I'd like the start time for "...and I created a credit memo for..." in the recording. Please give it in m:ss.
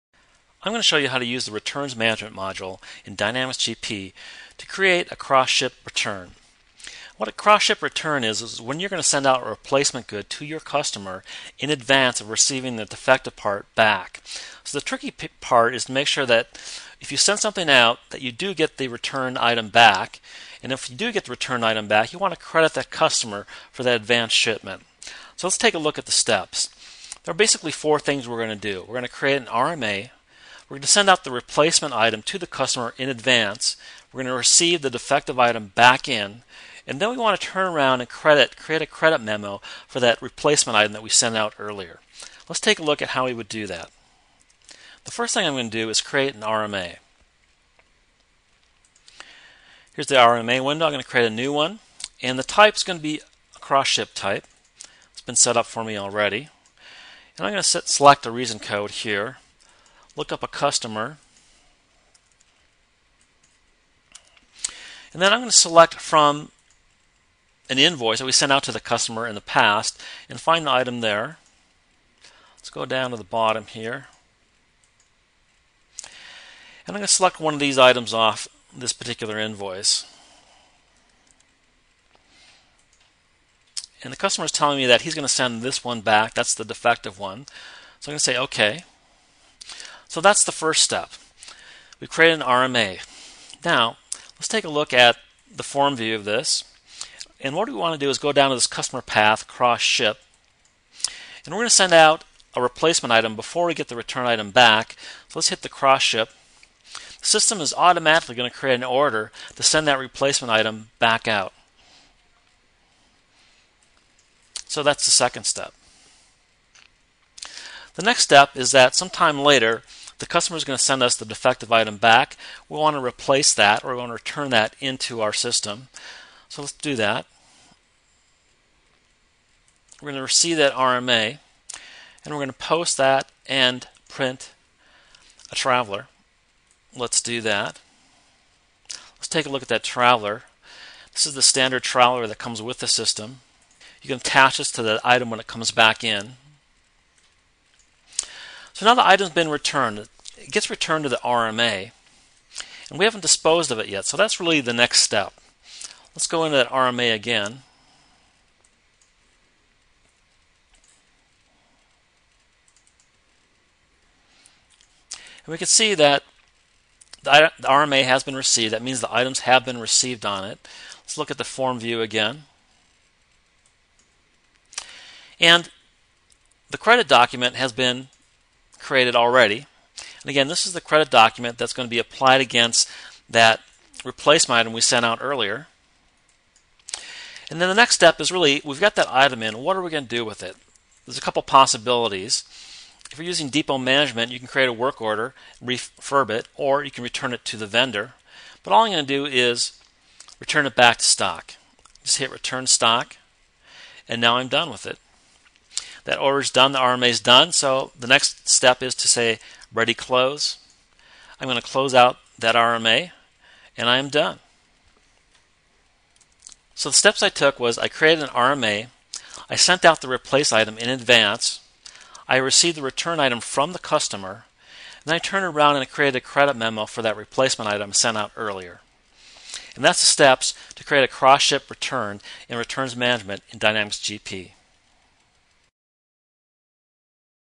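3:45.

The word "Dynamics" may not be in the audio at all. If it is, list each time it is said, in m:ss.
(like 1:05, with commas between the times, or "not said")
0:03, 3:53.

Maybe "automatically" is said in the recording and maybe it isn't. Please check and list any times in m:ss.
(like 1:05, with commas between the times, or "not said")
1:47.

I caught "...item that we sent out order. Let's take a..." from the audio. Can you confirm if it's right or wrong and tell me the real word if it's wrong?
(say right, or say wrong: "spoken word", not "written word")
wrong: "earlier", not "order".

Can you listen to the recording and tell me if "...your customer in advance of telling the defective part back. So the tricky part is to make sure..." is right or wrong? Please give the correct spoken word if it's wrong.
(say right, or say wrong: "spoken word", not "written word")
wrong: "receiving", not "telling".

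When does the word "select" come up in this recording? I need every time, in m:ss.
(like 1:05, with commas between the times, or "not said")
0:57, 1:05, 1:17.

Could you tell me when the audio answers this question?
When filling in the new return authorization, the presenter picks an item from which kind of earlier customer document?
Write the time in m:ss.
1:07.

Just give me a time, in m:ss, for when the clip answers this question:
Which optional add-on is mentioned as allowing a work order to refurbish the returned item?
3:13.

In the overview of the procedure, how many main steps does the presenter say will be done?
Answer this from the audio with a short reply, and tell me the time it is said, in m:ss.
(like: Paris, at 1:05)
4, at 0:27.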